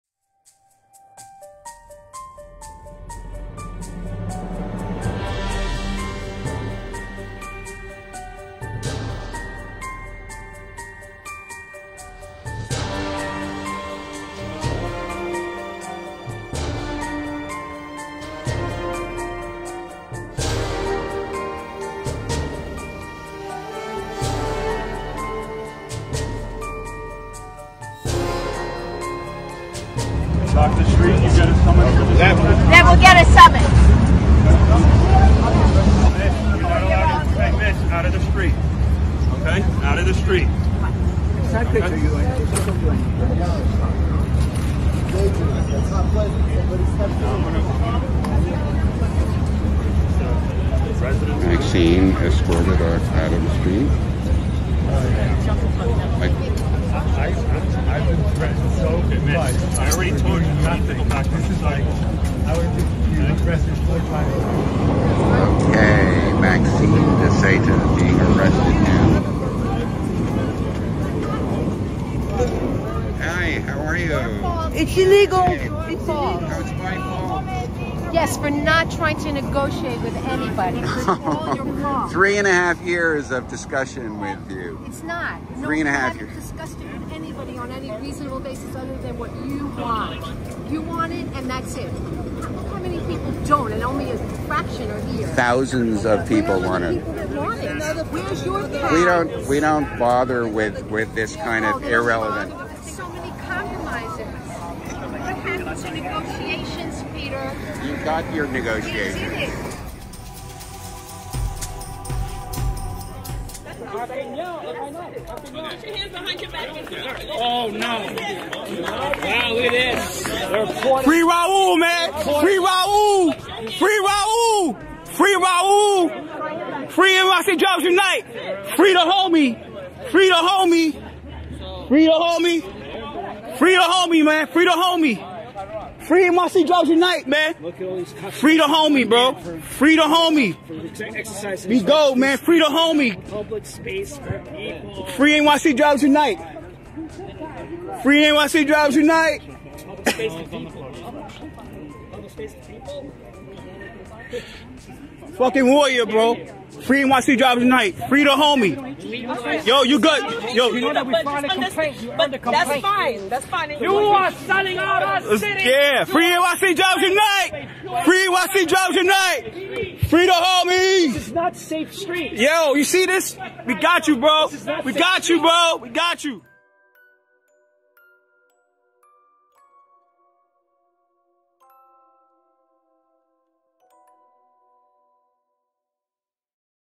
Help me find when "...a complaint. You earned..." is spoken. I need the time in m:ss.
2:41.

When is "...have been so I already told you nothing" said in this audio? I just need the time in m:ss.
0:57.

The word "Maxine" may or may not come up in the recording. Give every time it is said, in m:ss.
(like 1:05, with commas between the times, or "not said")
0:51, 1:06.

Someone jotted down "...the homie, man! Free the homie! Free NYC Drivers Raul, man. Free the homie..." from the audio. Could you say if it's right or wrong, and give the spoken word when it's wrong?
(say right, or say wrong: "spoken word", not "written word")
wrong: "Unite", not "Raul".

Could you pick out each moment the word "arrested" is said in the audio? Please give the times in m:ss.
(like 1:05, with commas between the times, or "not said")
1:03, 1:08.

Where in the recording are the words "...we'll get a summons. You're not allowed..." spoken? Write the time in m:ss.
0:32.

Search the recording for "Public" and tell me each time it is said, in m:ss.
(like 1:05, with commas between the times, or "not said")
2:23.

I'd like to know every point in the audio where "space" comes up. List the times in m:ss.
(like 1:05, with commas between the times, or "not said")
2:23.